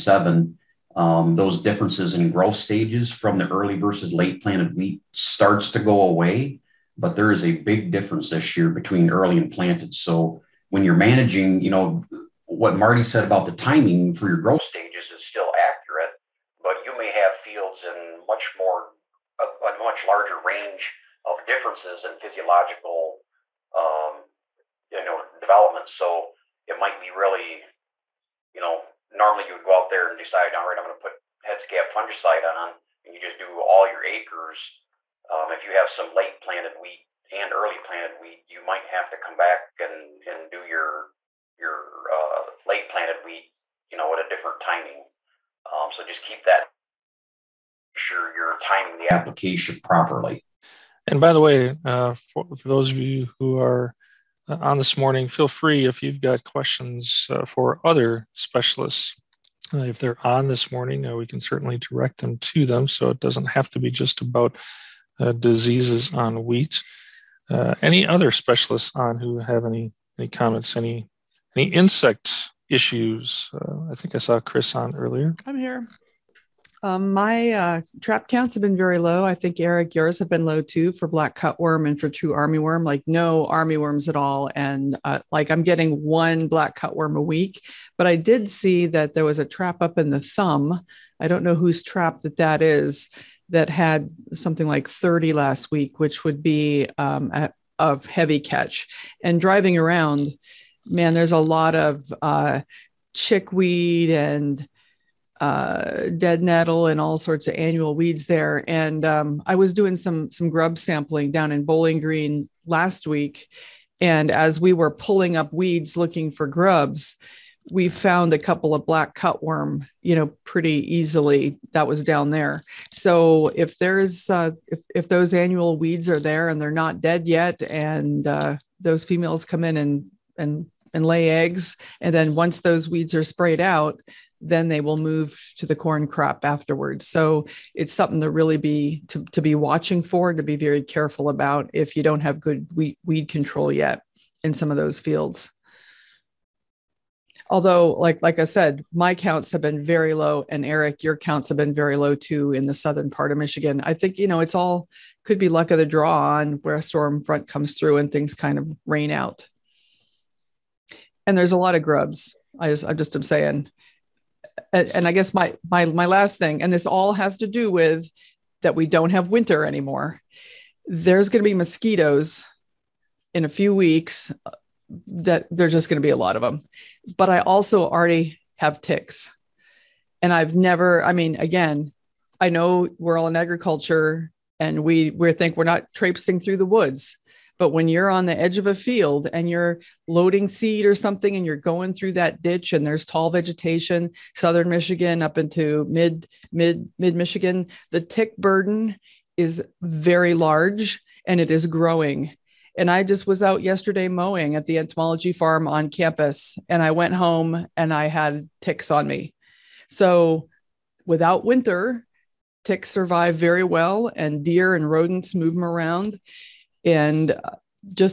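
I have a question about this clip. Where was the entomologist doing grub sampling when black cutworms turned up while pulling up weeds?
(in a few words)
Bowling Green.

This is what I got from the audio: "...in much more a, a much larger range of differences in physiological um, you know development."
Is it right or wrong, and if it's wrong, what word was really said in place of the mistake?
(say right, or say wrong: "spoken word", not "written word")
right.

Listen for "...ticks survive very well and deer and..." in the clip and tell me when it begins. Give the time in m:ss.
3:32.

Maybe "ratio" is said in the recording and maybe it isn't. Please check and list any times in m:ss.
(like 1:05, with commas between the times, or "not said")
not said.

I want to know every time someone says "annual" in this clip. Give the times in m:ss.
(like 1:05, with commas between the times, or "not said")
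1:47, 2:05.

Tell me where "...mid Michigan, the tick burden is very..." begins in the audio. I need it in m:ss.
3:16.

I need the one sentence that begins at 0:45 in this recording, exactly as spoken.
Um, so just keep that sure you're timing the application properly.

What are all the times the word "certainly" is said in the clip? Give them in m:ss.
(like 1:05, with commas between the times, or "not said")
1:01.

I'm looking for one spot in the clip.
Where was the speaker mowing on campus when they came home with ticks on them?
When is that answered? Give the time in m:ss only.
3:24.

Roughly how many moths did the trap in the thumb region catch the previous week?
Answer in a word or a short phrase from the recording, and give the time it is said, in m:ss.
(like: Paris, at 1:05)
30, at 1:34.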